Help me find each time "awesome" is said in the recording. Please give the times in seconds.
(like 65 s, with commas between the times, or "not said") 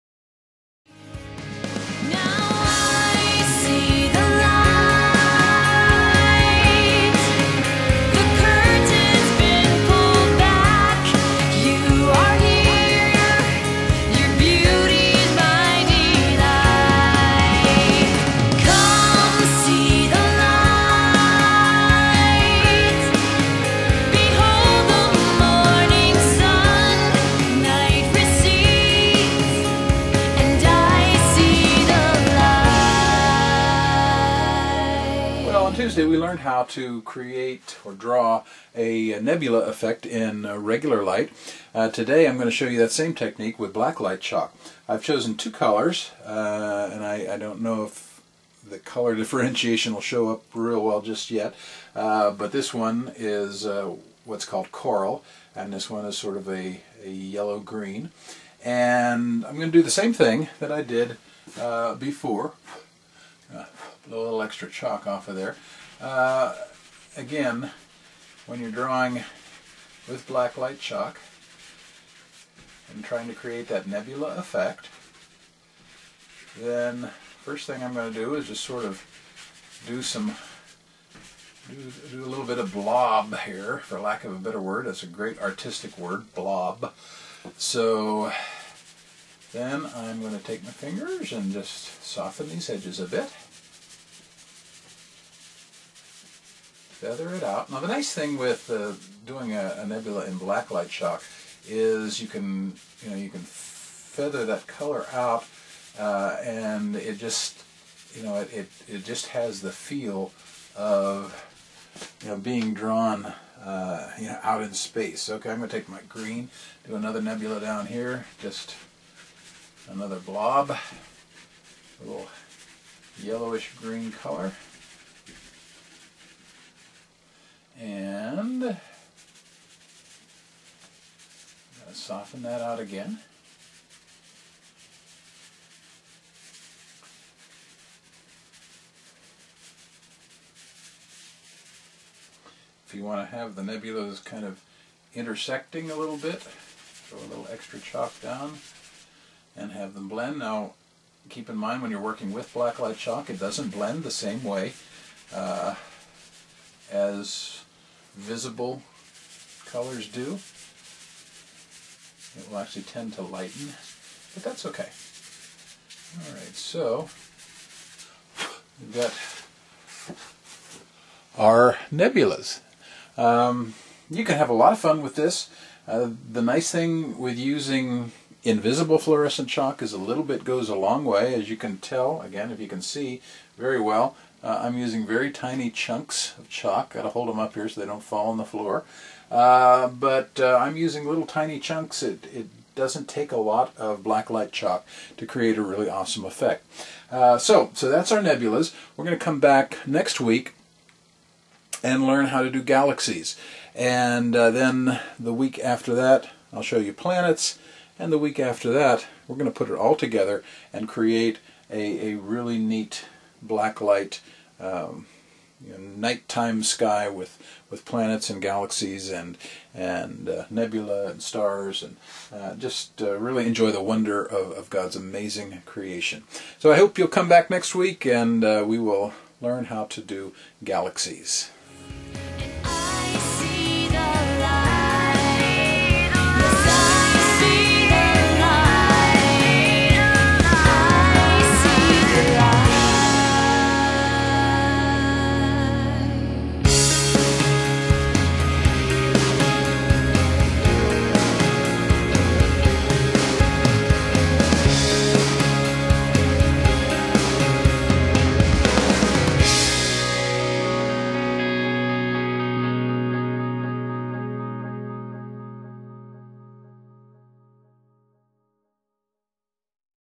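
195 s.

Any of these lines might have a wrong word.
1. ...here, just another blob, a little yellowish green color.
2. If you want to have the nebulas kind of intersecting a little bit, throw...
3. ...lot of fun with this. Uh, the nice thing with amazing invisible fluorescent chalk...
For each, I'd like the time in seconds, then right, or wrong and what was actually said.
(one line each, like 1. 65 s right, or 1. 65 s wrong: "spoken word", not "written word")
1. 117 s right
2. 142 s right
3. 174 s wrong: "using", not "amazing".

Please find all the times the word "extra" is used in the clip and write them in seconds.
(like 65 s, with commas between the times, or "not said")
64 s, 147 s.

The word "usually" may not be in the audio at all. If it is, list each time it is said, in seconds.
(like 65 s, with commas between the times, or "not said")
not said.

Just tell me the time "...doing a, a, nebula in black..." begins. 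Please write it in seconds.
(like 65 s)
99 s.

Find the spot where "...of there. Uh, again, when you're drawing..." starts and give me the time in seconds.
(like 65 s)
65 s.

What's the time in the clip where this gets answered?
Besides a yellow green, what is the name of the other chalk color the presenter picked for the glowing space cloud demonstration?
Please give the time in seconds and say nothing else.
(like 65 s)
54 s.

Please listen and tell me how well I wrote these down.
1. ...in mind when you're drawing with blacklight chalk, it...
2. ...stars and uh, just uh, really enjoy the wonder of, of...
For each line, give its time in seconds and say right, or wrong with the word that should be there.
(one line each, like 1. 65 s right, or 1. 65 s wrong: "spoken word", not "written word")
1. 151 s wrong: "working", not "drawing"
2. 221 s right.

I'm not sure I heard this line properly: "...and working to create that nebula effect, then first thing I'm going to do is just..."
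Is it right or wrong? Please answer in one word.
wrong.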